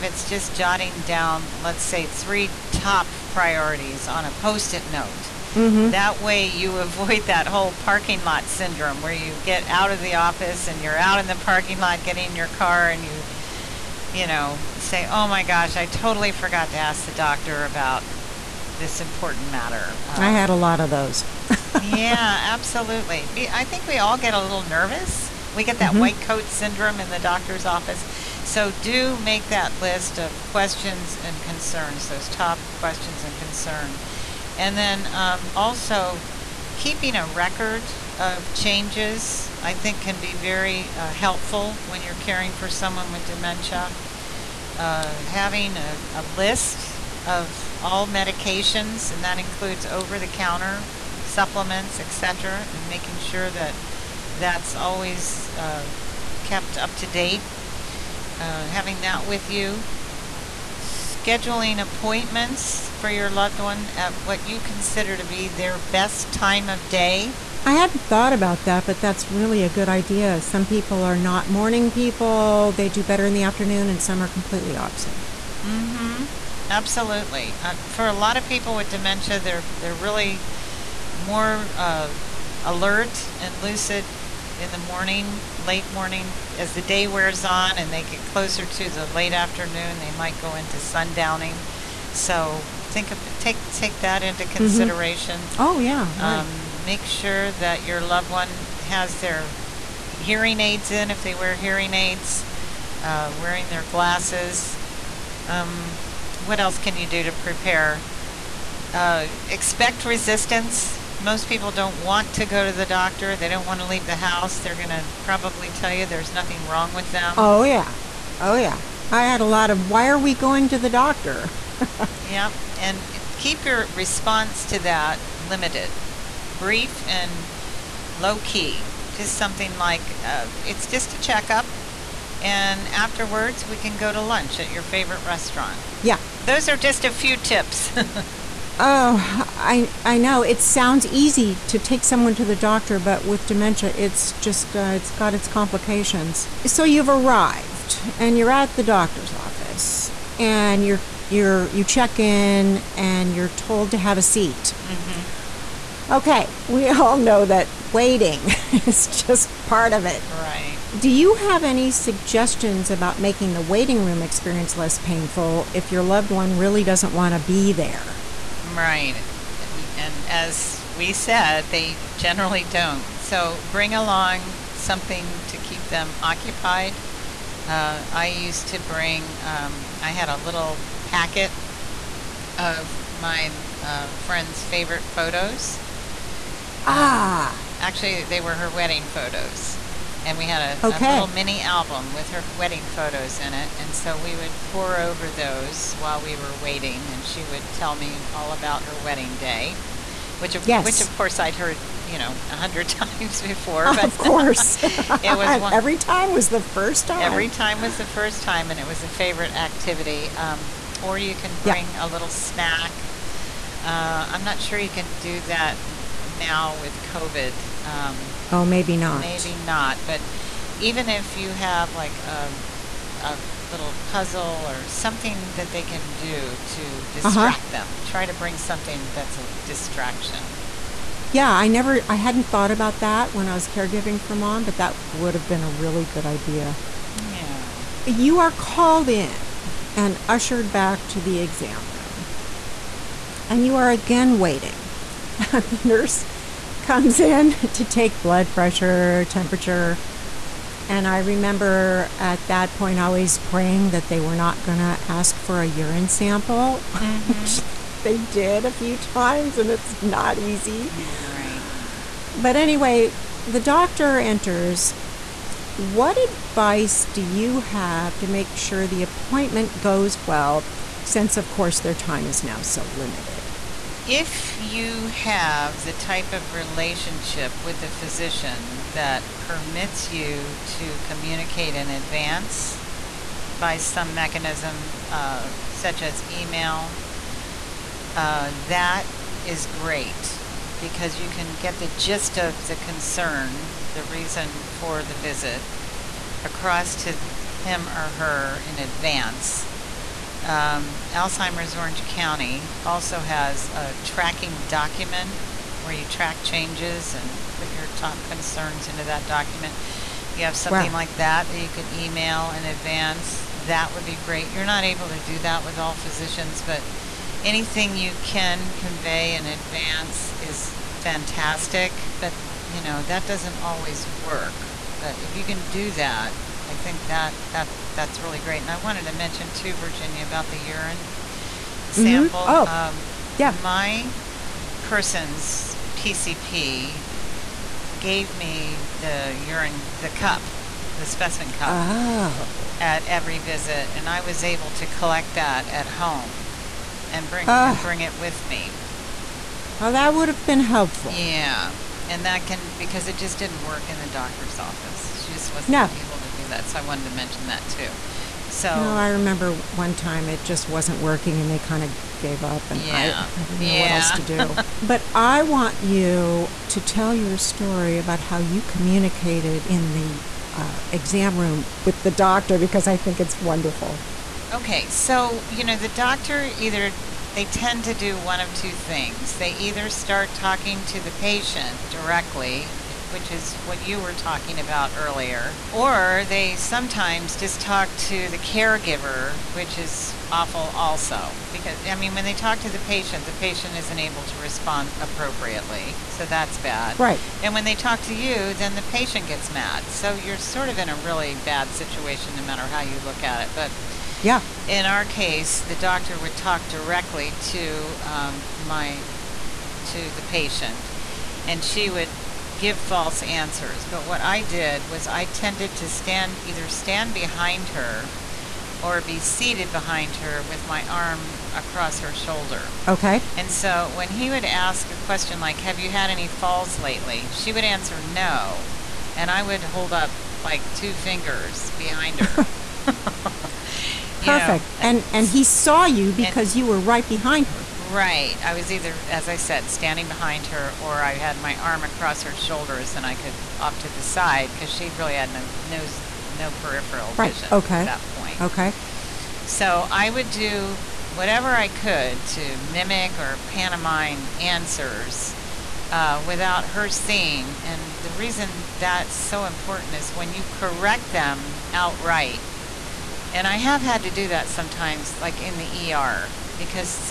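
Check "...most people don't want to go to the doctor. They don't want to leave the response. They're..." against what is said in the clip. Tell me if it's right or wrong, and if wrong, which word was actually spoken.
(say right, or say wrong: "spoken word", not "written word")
wrong: "house", not "response".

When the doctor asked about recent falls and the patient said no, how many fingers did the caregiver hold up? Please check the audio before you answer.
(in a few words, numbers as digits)
2.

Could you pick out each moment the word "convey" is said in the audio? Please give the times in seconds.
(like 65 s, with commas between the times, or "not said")
318 s.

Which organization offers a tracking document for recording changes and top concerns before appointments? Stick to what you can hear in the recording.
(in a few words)
Alzheimer's Orange County.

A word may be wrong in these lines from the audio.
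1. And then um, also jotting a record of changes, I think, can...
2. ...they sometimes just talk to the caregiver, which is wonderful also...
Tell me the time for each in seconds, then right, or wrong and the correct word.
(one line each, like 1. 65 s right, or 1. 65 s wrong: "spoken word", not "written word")
1. 34 s wrong: "keeping", not "jotting"
2. 386 s wrong: "awful", not "wonderful".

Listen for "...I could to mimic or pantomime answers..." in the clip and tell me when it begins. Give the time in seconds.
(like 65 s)
451 s.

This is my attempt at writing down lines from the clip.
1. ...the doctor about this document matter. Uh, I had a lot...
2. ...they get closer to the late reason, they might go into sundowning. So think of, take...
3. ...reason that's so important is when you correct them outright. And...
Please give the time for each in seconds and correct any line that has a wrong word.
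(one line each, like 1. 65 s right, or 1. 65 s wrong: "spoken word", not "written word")
1. 17 s wrong: "important", not "document"
2. 87 s wrong: "afternoon", not "reason"
3. 458 s right.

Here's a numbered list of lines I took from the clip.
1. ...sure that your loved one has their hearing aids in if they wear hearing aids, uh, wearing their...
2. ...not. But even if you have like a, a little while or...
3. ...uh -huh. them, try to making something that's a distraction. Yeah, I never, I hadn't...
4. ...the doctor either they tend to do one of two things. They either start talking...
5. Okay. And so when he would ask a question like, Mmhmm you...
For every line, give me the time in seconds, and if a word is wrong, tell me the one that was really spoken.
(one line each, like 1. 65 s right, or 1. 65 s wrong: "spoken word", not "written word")
1. 97 s right
2. 219 s wrong: "puzzle", not "while"
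3. 227 s wrong: "bring", not "making"
4. 375 s right
5. 422 s wrong: "Have", not "Mmhmm".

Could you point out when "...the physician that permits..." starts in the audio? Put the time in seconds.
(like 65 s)
277 s.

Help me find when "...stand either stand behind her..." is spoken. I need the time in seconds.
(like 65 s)
415 s.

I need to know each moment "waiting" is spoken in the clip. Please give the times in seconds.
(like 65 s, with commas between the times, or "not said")
157 s, 163 s, 196 s, 244 s.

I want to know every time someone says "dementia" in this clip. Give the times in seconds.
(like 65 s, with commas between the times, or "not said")
43 s, 78 s, 143 s.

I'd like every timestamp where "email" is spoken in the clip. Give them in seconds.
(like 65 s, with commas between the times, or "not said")
286 s, 311 s.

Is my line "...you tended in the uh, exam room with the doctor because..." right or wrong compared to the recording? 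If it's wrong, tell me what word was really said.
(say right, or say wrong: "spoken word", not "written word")
wrong: "communicated", not "tended".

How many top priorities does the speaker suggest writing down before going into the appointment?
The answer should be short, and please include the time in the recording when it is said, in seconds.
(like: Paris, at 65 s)
3, at 2 s.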